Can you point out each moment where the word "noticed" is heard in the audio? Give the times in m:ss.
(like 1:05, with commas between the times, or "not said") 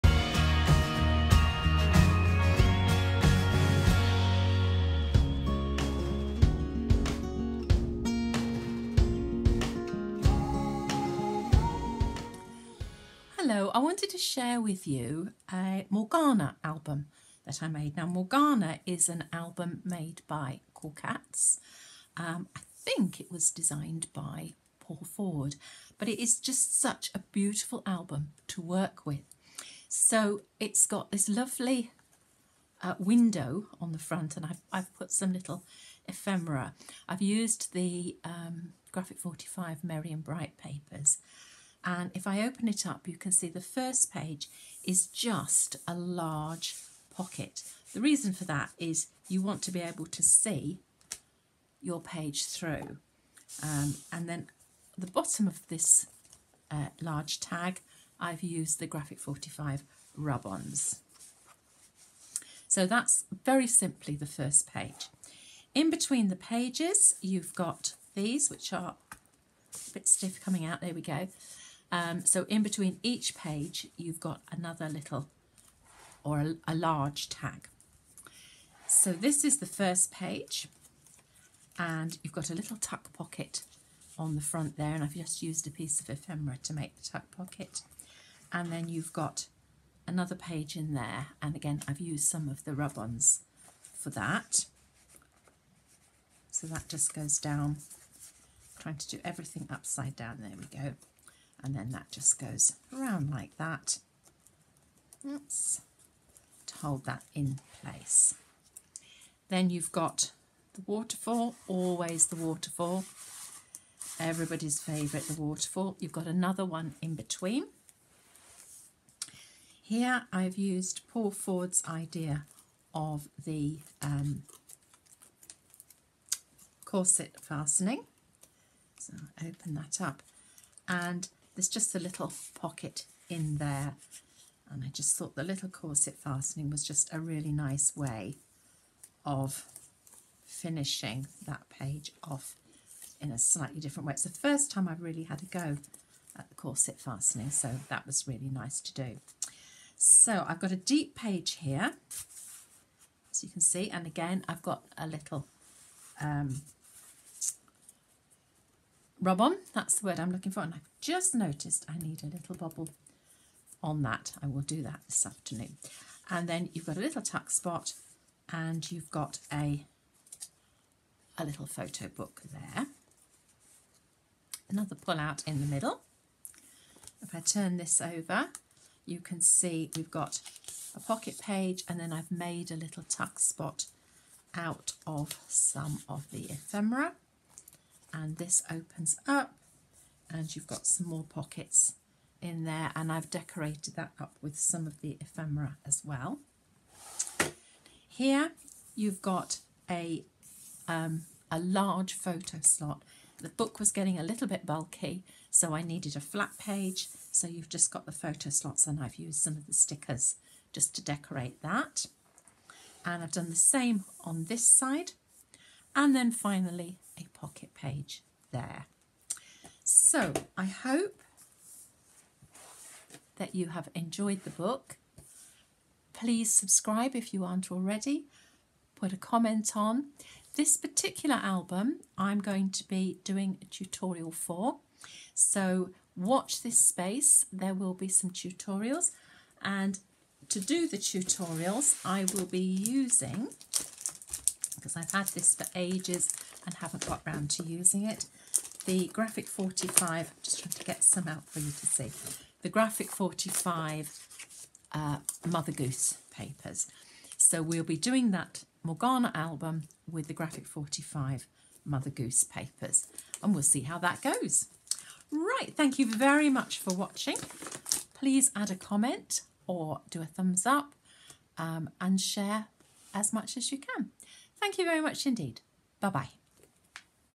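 2:41.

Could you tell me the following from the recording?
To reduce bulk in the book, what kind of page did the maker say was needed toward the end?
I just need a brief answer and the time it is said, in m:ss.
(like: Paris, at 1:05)
A flat page, at 3:26.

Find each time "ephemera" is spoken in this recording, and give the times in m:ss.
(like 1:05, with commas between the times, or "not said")
0:36, 1:26, 3:06, 3:15.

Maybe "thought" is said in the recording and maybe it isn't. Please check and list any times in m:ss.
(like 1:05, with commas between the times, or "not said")
2:15.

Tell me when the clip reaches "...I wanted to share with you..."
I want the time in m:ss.
0:13.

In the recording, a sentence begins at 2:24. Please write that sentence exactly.
It's the first time I've really had a go at the corset fastening so that was really nice to do.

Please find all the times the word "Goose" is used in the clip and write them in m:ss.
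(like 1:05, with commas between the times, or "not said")
4:15, 4:22.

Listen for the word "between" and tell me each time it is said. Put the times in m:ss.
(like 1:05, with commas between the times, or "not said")
1:05, 1:12, 1:57.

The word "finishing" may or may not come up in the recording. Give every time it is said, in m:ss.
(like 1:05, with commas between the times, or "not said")
2:20.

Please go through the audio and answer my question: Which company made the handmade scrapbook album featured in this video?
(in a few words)
Cool Cats.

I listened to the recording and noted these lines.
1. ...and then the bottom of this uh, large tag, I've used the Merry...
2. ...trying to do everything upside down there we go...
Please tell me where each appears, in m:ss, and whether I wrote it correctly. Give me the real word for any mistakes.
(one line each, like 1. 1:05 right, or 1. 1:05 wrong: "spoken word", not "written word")
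1. 0:54 wrong: "Graphic", not "Merry"
2. 1:38 right.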